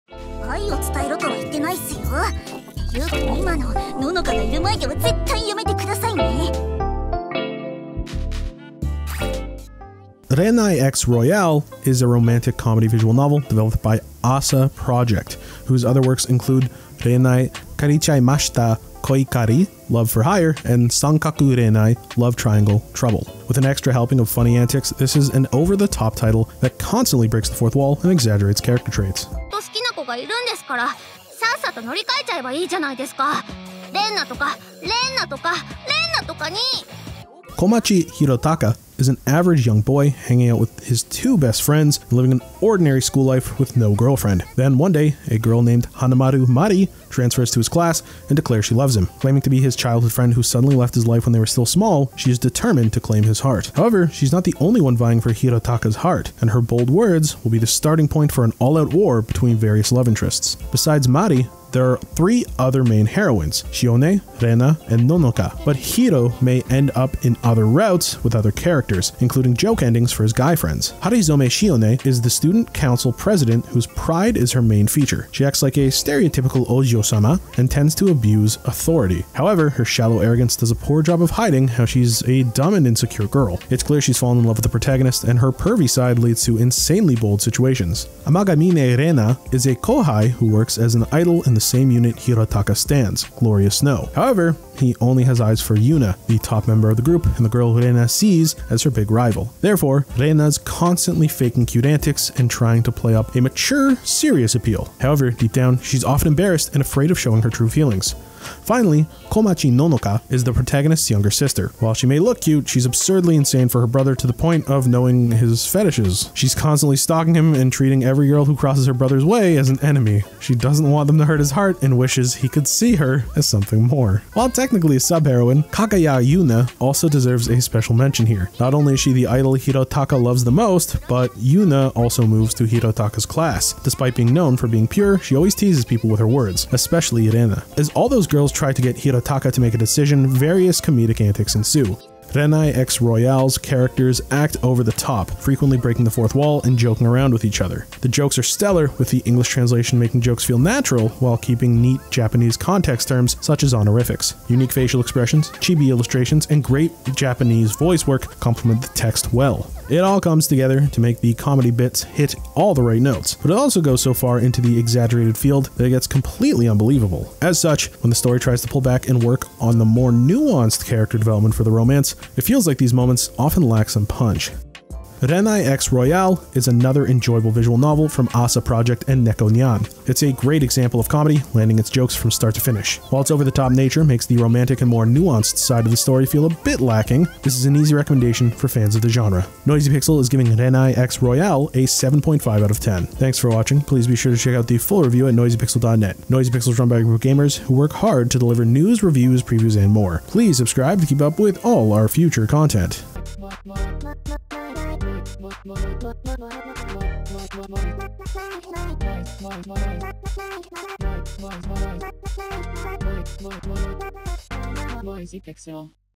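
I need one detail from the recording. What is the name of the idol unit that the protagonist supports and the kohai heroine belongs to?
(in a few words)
Glorious Snow.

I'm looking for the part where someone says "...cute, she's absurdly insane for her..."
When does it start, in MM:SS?
01:52.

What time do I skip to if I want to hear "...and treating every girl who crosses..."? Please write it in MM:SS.
01:57.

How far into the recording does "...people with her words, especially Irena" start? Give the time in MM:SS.
02:15.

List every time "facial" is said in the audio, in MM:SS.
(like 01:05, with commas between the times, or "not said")
02:34.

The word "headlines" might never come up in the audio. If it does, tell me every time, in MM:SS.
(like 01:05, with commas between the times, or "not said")
not said.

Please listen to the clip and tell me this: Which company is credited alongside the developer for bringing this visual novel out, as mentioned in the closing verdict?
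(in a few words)
NekoNyan.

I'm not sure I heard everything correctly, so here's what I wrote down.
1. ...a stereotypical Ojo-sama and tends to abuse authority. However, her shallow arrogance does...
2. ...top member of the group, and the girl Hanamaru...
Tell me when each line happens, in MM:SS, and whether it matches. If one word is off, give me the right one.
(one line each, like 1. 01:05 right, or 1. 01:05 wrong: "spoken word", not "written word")
1. 01:15 right
2. 01:36 wrong: "Rena", not "Hanamaru".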